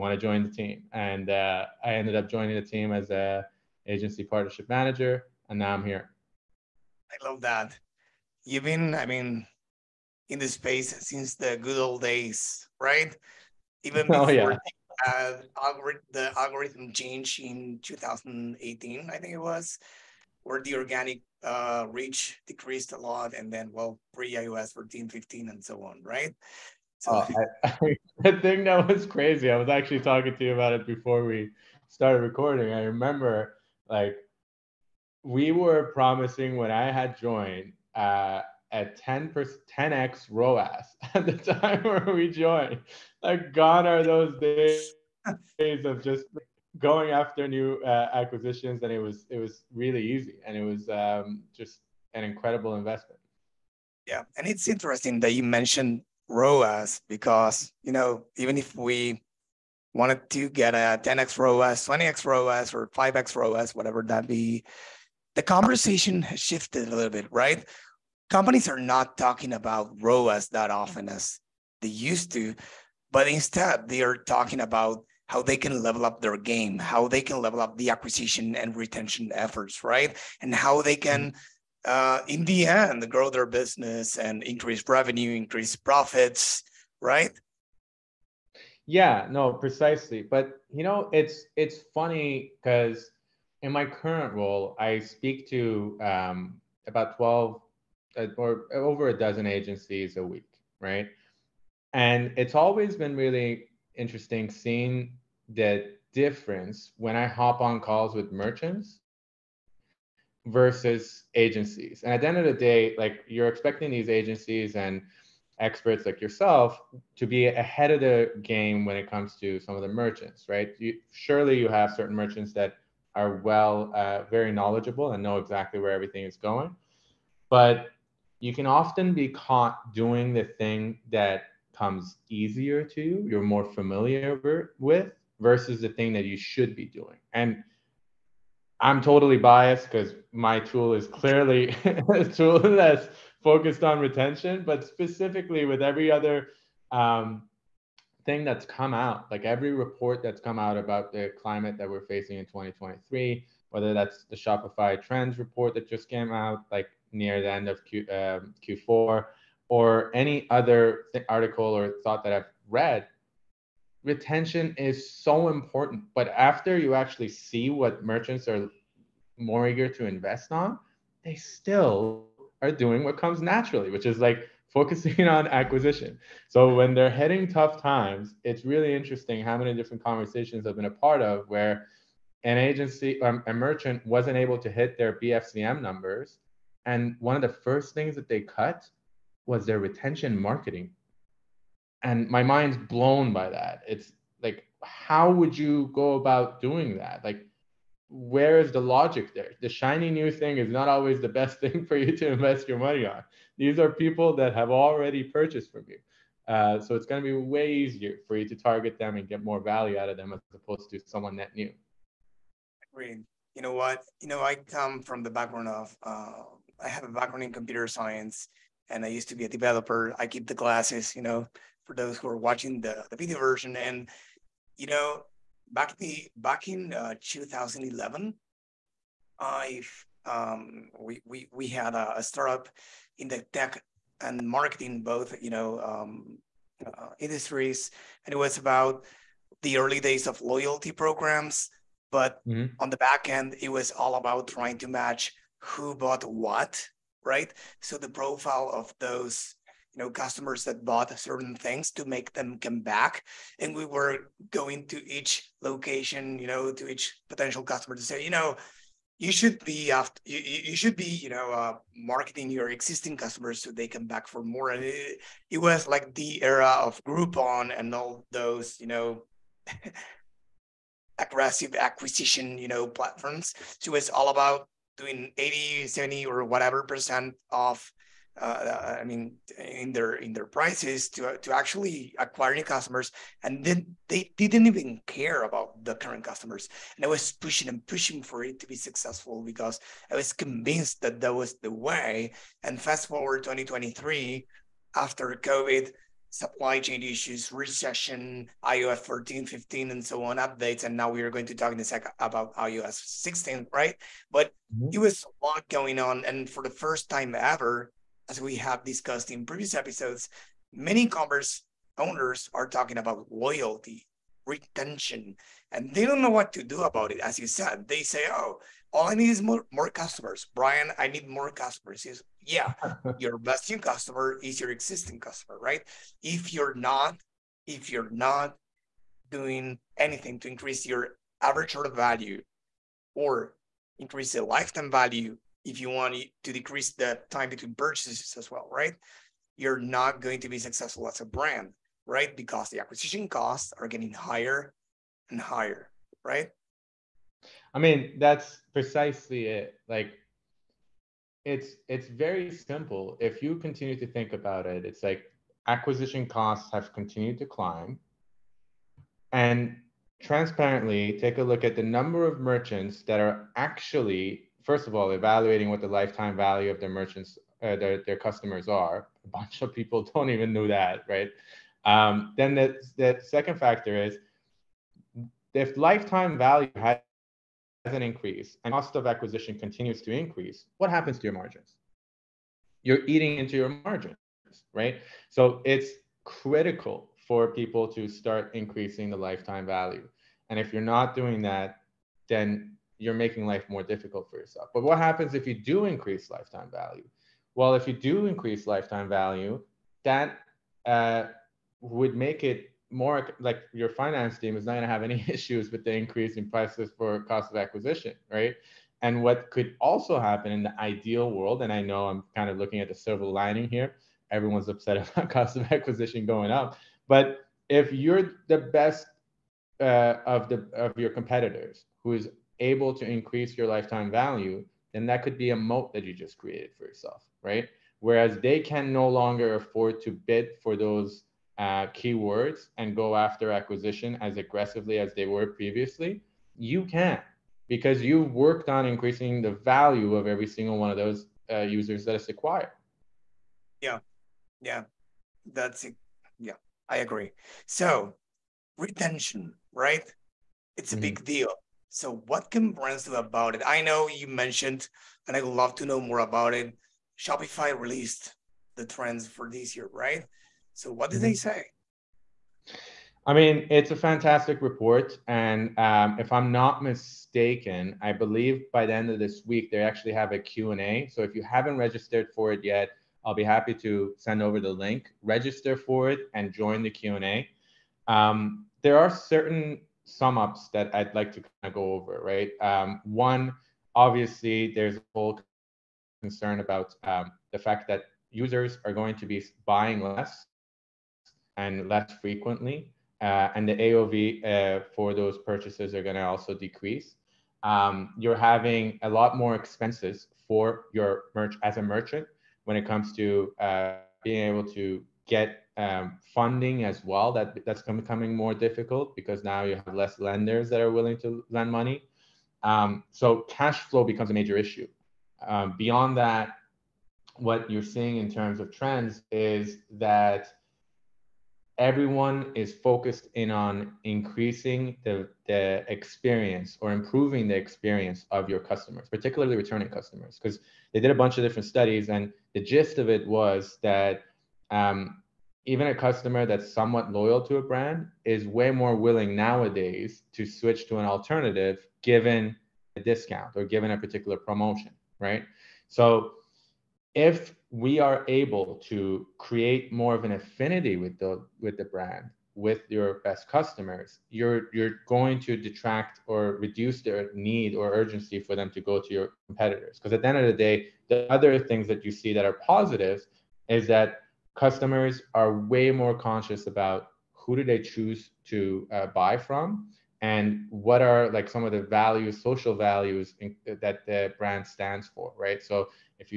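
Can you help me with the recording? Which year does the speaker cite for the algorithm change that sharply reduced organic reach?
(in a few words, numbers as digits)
2018.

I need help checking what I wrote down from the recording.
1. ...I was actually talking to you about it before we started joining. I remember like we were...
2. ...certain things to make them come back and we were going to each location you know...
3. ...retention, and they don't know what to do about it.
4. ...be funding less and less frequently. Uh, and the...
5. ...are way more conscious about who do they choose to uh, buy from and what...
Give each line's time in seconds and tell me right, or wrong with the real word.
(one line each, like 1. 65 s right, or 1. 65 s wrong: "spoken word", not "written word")
1. 29 s wrong: "recording", not "joining"
2. 251 s right
3. 314 s right
4. 489 s wrong: "buying", not "funding"
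5. 565 s right.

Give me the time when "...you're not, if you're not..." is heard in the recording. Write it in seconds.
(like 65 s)
326 s.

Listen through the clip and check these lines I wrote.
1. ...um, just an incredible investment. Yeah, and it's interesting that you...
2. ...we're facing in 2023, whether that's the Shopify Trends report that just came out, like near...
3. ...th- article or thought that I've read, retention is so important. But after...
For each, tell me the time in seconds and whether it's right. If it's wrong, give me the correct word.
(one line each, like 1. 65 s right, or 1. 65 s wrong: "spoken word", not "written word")
1. 50 s right
2. 151 s right
3. 161 s right.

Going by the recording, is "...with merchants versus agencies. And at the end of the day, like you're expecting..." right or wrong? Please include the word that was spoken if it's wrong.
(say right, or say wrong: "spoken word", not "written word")
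right.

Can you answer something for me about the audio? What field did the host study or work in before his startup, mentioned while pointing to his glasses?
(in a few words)
Computer science.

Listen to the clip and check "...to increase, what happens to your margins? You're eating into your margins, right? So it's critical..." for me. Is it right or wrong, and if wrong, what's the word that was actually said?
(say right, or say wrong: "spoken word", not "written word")
right.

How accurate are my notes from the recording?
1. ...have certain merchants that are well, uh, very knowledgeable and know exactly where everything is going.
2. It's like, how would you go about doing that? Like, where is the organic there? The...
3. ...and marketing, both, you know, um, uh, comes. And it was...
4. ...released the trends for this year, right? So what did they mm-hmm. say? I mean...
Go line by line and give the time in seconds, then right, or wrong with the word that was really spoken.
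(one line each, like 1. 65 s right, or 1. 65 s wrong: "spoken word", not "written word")
1. 121 s right
2. 193 s wrong: "logic", not "organic"
3. 234 s wrong: "industries", not "comes"
4. 457 s right.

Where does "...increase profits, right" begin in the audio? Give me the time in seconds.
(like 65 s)
85 s.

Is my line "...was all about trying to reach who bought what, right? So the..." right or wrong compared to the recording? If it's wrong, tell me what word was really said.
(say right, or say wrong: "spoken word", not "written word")
wrong: "match", not "reach".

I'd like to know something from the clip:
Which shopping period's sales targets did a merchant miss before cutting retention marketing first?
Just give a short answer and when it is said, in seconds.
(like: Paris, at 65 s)
BFCM, at 185 s.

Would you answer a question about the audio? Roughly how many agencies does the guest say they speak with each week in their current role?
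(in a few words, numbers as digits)
Over a dozen.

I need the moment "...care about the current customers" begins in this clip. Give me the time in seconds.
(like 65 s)
285 s.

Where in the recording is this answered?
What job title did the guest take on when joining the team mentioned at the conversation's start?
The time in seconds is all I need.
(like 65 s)
3 s.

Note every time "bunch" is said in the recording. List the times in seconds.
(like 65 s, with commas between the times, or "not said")
369 s, 531 s.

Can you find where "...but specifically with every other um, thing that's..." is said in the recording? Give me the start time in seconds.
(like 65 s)
144 s.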